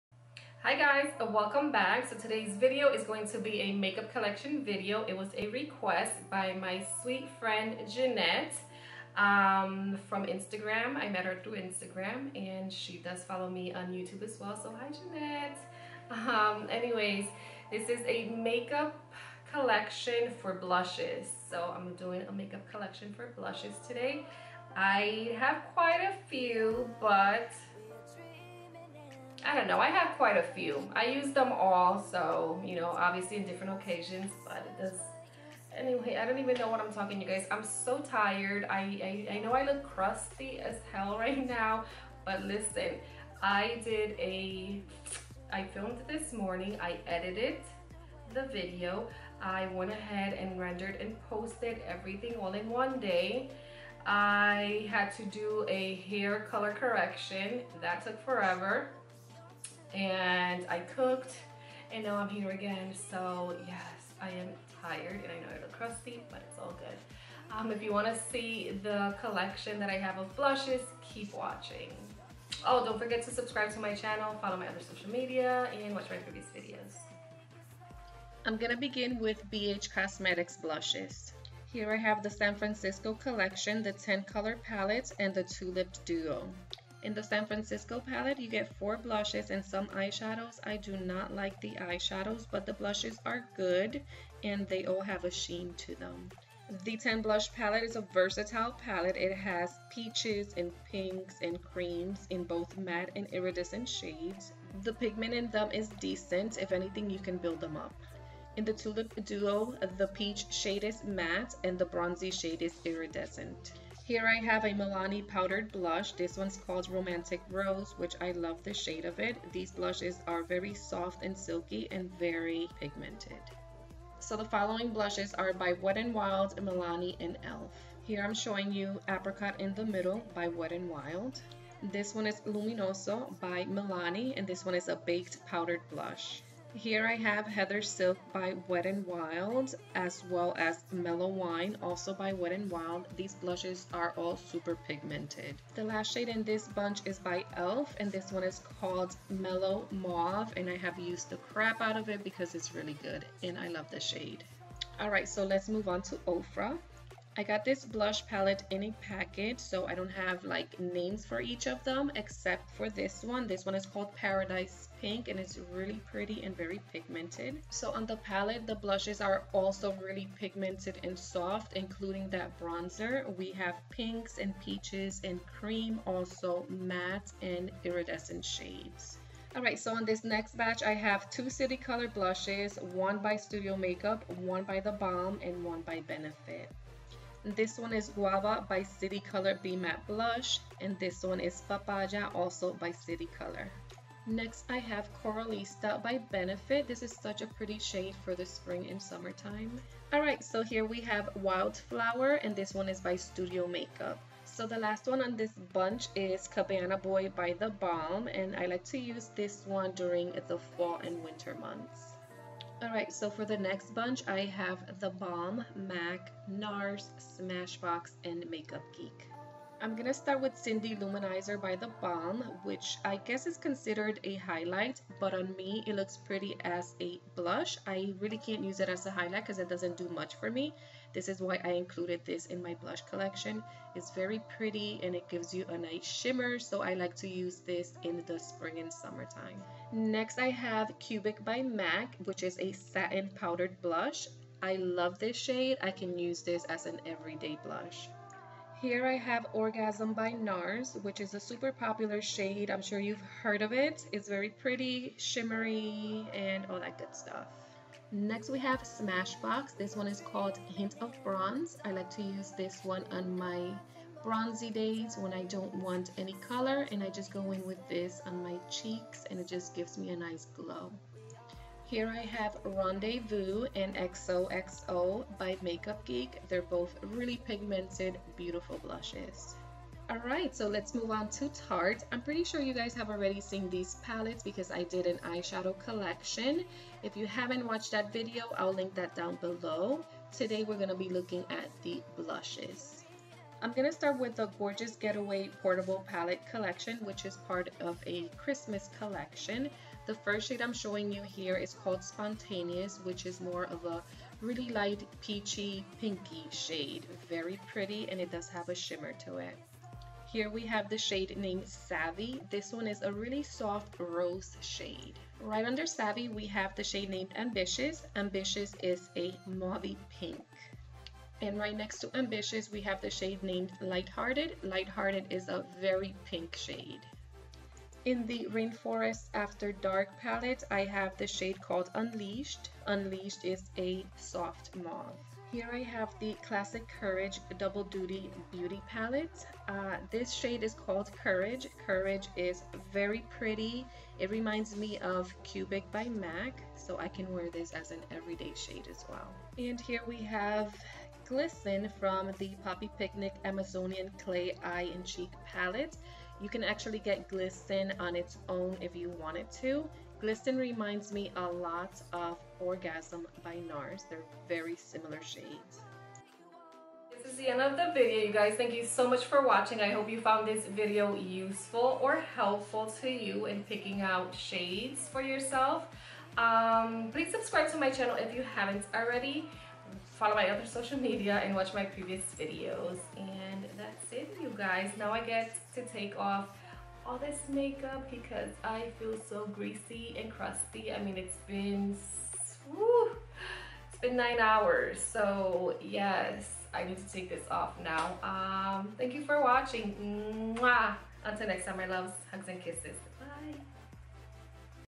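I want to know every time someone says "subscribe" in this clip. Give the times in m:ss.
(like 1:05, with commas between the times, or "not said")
1:13, 6:17.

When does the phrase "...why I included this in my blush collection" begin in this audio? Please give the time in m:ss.
3:51.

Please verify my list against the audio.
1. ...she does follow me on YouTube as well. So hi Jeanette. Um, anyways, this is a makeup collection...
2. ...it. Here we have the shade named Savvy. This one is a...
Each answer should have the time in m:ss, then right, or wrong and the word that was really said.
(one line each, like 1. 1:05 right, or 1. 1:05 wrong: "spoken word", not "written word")
1. 0:12 right
2. 5:09 right.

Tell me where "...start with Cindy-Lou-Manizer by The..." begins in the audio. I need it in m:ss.
3:40.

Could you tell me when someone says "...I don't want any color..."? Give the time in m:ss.
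4:25.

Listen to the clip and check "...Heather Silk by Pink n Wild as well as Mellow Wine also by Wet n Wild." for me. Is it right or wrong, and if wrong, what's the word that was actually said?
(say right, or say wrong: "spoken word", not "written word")
wrong: "Wet", not "Pink".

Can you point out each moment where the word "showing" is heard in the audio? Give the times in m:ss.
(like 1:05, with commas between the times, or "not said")
2:08, 5:00.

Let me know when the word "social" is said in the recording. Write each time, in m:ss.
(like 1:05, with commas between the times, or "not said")
1:14, 6:20.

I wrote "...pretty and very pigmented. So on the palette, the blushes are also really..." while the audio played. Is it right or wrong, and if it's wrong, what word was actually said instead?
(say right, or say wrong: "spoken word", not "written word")
right.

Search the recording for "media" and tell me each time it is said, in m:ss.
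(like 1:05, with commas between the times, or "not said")
1:15, 6:20.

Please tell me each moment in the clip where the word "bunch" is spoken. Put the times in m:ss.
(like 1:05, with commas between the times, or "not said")
2:26, 3:25, 3:33.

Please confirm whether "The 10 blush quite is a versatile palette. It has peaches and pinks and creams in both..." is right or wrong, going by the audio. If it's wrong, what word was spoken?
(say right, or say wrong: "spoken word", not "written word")
wrong: "palette", not "quite".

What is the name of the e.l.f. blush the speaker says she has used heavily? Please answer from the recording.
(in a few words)
Mellow Mauve.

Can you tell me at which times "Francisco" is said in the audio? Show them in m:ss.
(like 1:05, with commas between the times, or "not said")
1:22, 1:27.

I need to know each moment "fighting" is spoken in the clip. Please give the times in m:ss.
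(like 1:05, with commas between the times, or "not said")
not said.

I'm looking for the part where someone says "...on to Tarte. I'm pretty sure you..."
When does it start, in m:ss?
4:41.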